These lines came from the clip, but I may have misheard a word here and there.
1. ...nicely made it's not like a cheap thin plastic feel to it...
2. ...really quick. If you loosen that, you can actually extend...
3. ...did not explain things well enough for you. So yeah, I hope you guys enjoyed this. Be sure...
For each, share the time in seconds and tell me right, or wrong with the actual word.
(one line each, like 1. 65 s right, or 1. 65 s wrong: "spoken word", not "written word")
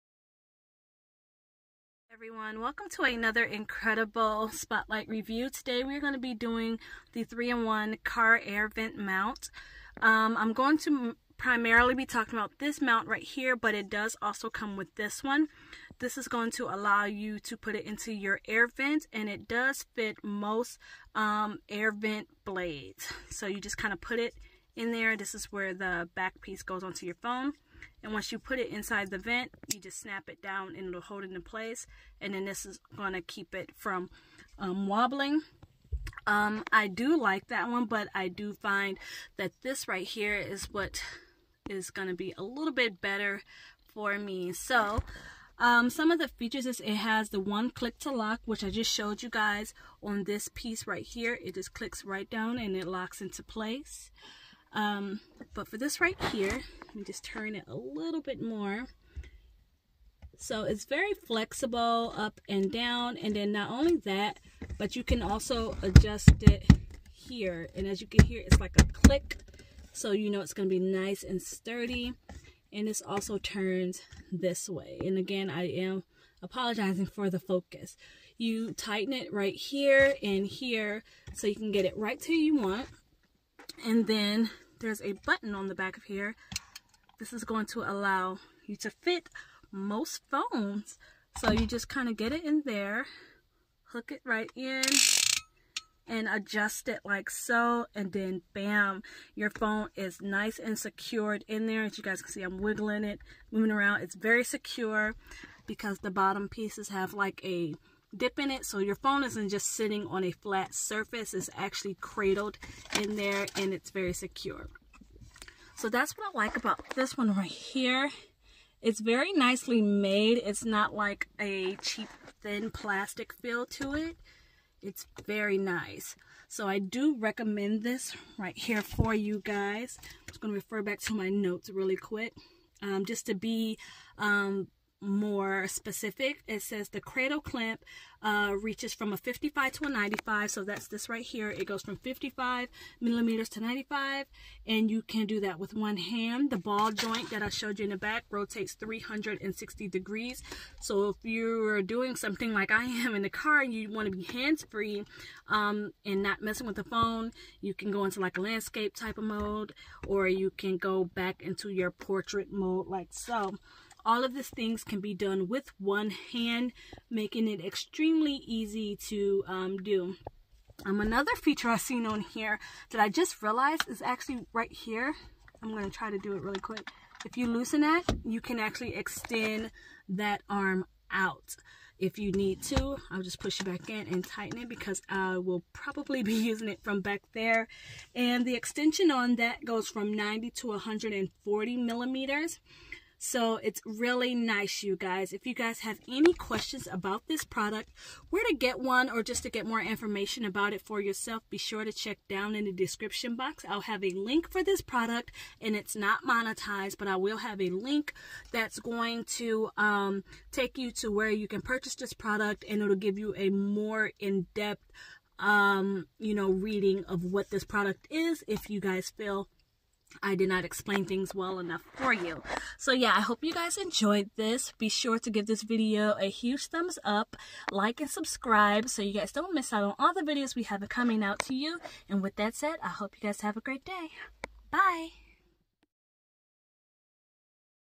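1. 119 s right
2. 176 s right
3. 220 s right.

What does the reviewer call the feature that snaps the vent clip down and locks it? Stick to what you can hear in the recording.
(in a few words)
one click to lock.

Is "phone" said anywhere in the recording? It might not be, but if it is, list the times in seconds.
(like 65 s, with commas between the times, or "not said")
27 s, 90 s, 99 s, 108 s, 156 s.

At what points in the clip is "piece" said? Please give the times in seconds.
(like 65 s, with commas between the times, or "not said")
26 s, 50 s, 106 s.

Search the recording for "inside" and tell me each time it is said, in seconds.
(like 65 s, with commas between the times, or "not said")
28 s.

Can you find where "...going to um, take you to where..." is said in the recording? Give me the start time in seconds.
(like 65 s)
208 s.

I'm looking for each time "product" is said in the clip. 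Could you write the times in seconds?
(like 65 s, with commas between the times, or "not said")
197 s, 204 s, 212 s, 217 s.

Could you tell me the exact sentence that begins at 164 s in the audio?
All of these things can be done with one hand, making it extremely easy to um, do.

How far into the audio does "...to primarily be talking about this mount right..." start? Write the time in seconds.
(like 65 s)
10 s.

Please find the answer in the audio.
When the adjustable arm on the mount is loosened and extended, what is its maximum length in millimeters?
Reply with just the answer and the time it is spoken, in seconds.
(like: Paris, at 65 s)
140 millimeters, at 190 s.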